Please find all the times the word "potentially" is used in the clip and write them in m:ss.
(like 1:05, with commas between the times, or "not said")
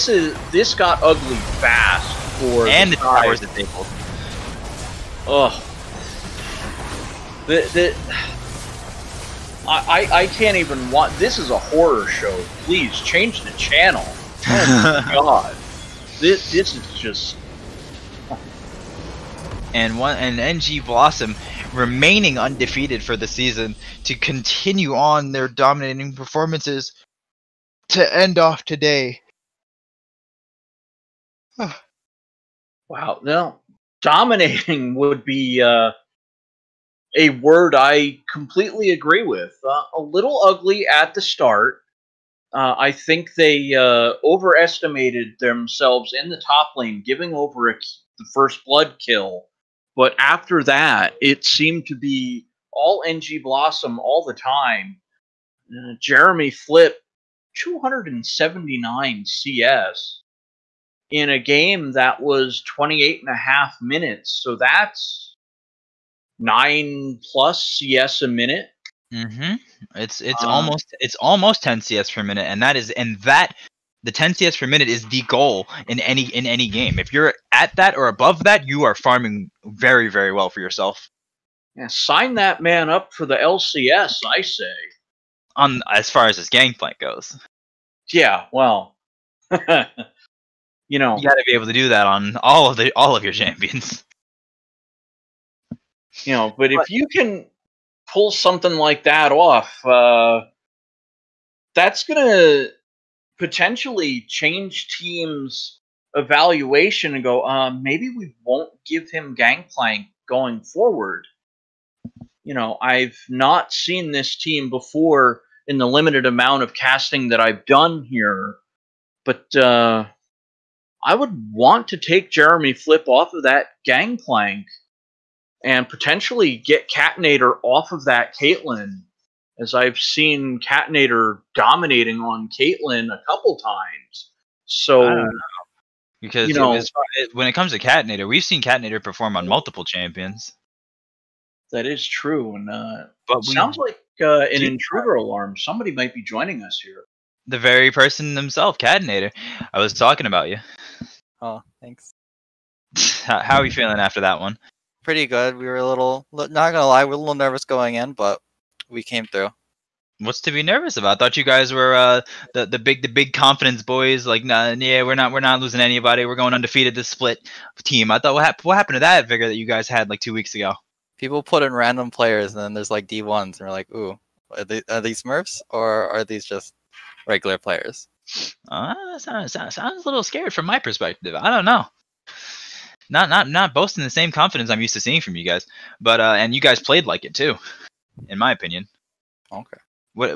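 1:43, 2:05.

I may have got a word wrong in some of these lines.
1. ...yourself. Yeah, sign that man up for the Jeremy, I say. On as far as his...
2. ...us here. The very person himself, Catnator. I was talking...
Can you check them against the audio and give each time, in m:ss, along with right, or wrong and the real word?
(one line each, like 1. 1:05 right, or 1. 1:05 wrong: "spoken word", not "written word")
1. 1:20 wrong: "LCS", not "Jeremy"
2. 2:26 right.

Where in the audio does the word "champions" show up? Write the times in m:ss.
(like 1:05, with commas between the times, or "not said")
1:33, 2:19.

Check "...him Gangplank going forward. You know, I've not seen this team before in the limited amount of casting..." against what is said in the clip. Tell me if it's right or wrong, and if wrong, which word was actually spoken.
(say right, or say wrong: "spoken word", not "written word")
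right.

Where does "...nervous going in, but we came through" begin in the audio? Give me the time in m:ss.
2:37.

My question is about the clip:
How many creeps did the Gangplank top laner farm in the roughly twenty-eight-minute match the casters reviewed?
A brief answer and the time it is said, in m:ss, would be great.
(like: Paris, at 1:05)
279, at 0:57.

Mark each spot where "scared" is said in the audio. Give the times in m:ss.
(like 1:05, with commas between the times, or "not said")
3:00.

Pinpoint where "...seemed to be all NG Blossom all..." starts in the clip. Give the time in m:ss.
0:51.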